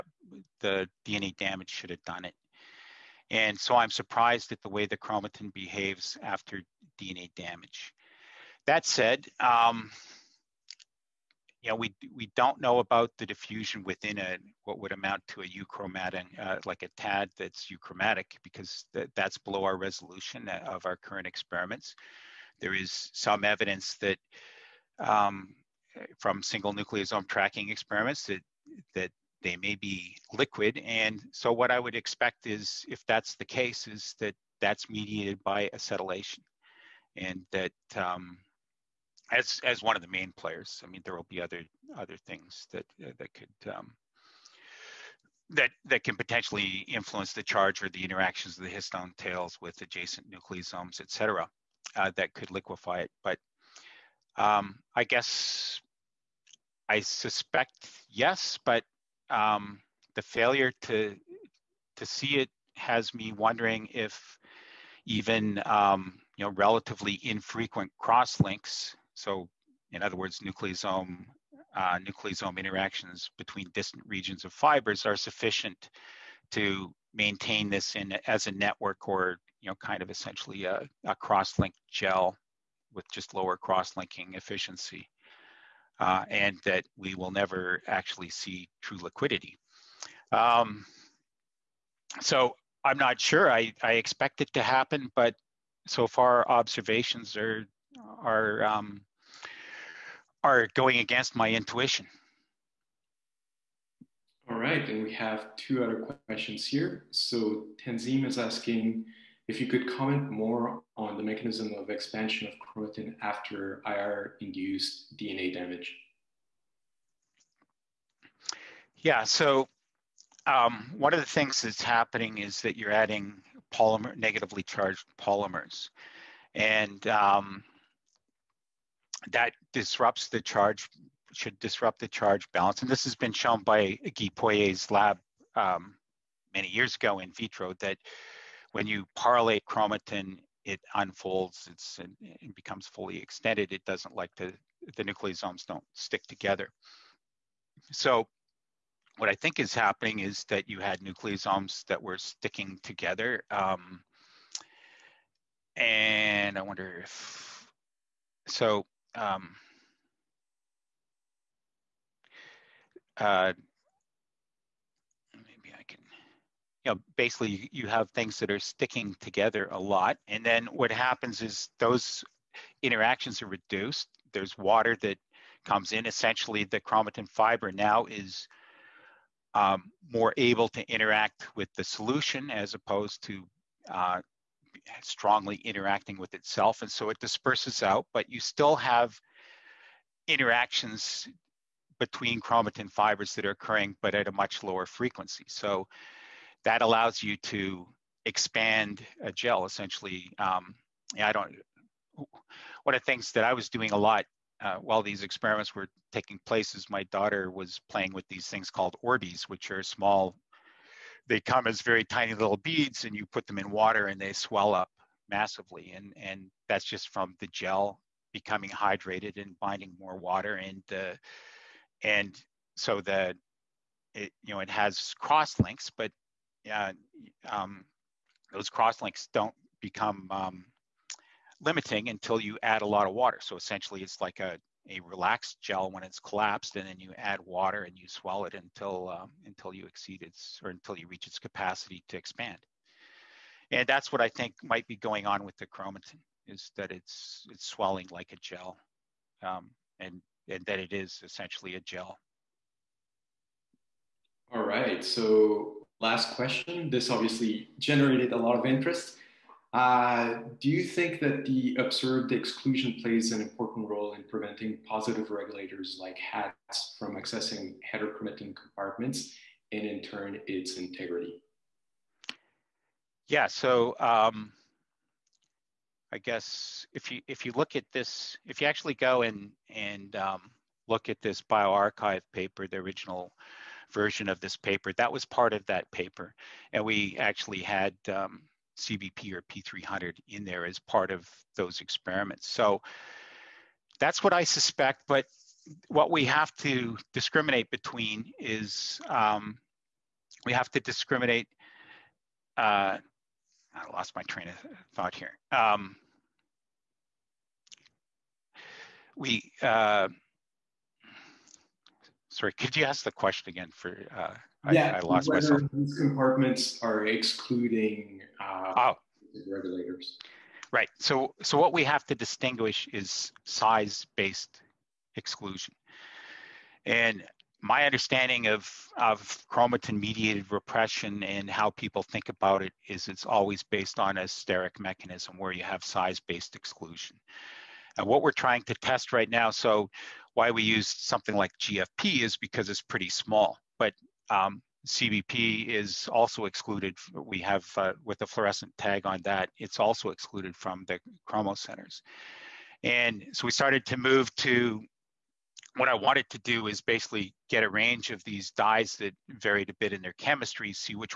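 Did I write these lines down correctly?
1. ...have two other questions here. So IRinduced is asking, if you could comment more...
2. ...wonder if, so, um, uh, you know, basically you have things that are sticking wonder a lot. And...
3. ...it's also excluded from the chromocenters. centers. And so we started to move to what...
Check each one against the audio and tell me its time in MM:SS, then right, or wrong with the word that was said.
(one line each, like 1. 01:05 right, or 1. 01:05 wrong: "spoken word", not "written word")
1. 01:45 wrong: "Tanzim", not "IRinduced"
2. 02:36 wrong: "together", not "wonder"
3. 05:49 right.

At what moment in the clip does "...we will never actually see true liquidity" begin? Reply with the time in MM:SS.
01:26.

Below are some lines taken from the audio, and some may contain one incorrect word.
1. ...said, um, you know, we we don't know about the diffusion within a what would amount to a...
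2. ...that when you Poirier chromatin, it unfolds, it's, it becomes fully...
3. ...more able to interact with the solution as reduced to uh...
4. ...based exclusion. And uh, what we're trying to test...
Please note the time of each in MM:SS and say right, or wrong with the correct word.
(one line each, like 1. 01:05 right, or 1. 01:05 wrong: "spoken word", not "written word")
1. 00:08 right
2. 02:17 wrong: "PARylate", not "Poirier"
3. 03:00 wrong: "opposed", not "reduced"
4. 05:36 right.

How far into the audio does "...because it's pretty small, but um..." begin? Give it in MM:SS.
05:42.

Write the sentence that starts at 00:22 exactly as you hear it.
There is some evidence that um, from single nucleosome tracking experiments that, that they may be liquid.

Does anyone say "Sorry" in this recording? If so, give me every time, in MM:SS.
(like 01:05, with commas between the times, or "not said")
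05:12.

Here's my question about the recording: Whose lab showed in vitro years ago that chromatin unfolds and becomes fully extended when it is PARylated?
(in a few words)
Guy Poirier's lab.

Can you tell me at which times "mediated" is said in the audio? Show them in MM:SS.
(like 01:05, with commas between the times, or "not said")
00:34, 05:29.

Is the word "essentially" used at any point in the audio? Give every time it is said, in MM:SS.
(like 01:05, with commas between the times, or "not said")
01:20, 02:56, 03:19, 03:53, 04:11.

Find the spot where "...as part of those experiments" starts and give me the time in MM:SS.
04:50.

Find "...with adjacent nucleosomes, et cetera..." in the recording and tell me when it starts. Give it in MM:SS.
00:49.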